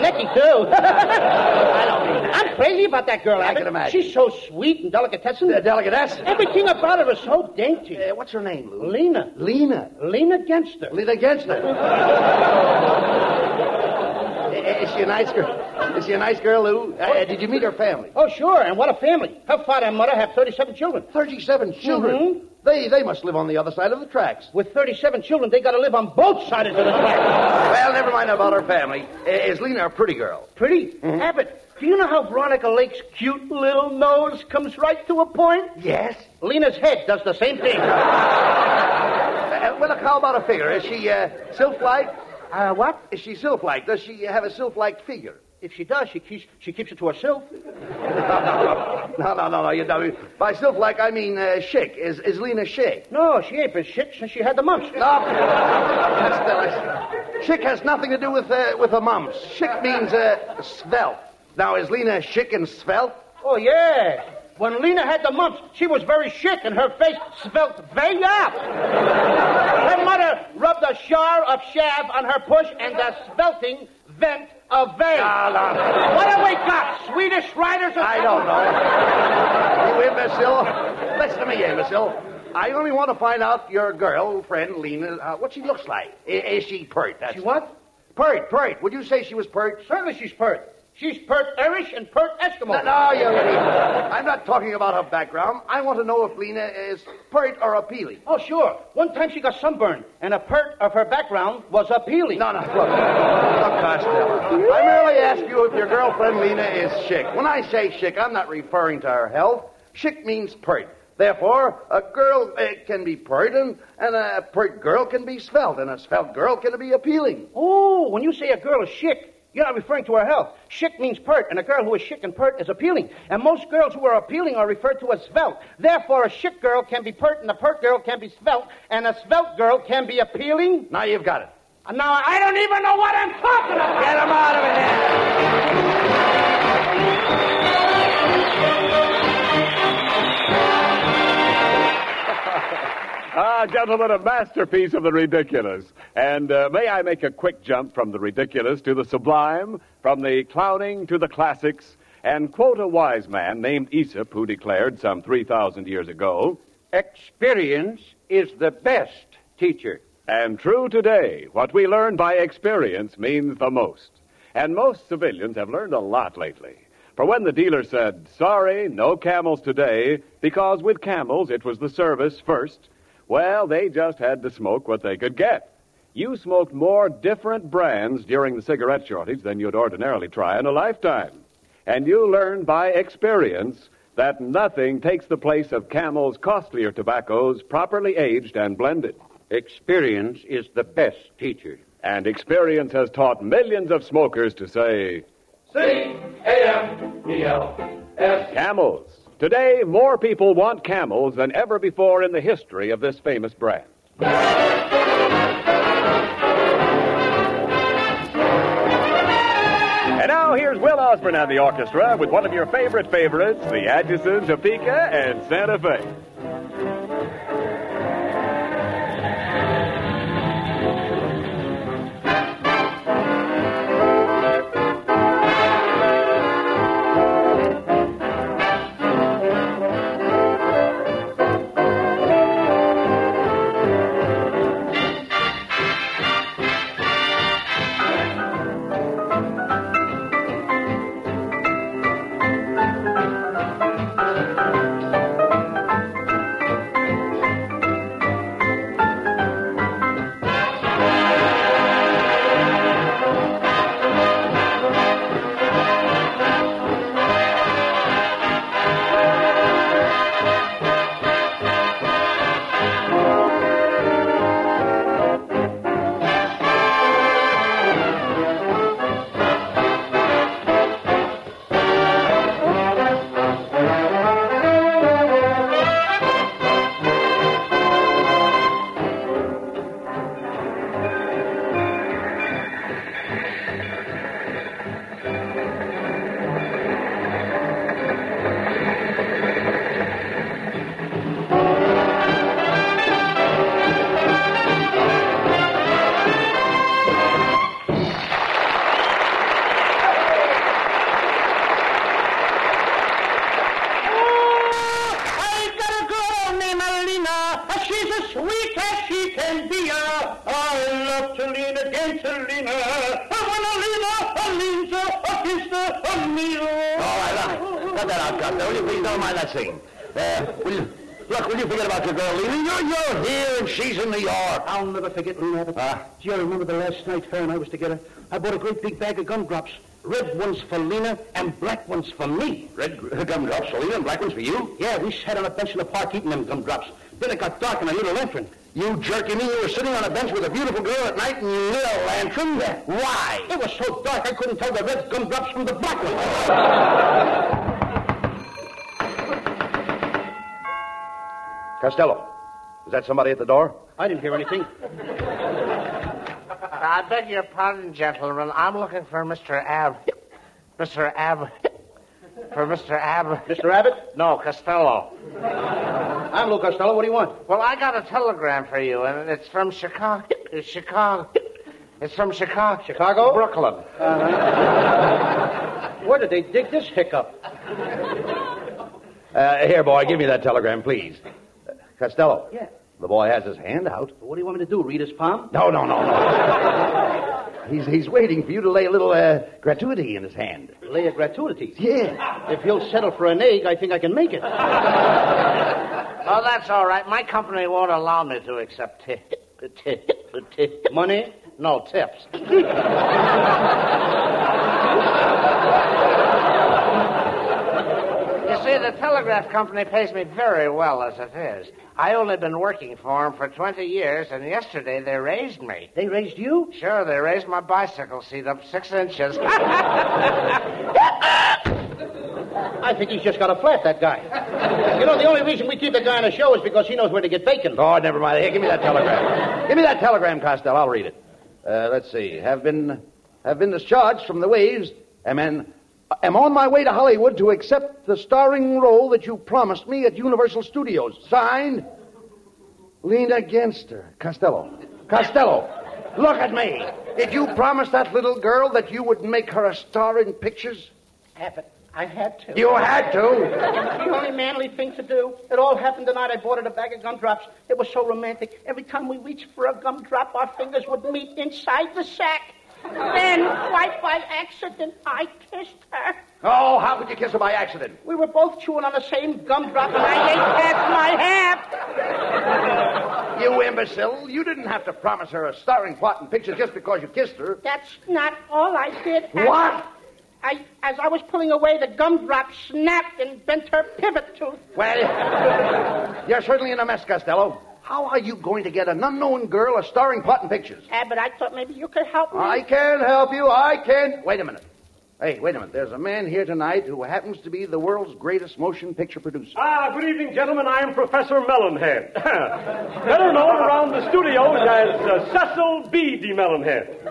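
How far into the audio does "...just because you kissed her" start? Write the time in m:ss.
7:56.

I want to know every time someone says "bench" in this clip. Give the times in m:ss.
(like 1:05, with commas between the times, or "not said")
5:35, 5:40.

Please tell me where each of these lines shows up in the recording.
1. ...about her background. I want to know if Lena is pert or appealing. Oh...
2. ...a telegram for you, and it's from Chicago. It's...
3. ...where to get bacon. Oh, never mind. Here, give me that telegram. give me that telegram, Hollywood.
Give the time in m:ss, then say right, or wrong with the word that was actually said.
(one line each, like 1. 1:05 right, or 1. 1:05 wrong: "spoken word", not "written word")
1. 1:34 right
2. 6:07 right
3. 7:07 wrong: "Costello", not "Hollywood".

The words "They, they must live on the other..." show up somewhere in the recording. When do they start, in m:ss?
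0:22.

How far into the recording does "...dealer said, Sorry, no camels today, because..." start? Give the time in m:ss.
2:47.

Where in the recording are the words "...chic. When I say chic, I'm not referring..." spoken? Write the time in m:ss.
1:47.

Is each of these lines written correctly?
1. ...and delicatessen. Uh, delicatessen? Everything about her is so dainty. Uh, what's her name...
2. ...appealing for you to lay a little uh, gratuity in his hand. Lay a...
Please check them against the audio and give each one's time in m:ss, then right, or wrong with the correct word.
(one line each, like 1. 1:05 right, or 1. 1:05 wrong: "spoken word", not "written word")
1. 0:04 right
2. 6:28 wrong: "waiting", not "appealing".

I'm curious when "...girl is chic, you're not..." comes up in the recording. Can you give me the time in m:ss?
1:58.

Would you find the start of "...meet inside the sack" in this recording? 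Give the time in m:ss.
7:41.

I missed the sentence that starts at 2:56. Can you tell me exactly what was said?
You smoked more different brands during the cigarette shortage than you'd ordinarily try in a lifetime.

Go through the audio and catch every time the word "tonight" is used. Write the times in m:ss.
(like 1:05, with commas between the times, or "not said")
7:36, 8:16.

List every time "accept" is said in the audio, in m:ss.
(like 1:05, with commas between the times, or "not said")
6:38, 7:17.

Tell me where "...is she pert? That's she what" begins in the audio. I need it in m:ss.
1:26.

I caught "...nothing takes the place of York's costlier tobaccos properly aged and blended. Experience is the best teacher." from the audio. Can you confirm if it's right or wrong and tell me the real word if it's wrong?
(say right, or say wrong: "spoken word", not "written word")
wrong: "Camel", not "York".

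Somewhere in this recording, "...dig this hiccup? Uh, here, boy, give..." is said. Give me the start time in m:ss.
6:16.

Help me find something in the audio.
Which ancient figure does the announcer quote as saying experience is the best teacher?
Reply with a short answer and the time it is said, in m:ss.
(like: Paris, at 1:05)
Aesop, at 2:33.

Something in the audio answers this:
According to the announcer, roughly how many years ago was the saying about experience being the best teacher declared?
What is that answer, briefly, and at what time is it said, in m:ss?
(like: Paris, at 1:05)
3,000 years, at 2:35.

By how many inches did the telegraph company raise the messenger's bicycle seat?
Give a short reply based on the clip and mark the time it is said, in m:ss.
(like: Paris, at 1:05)
6 inches, at 6:58.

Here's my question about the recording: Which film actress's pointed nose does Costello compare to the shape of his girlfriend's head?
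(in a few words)
Veronica Lake.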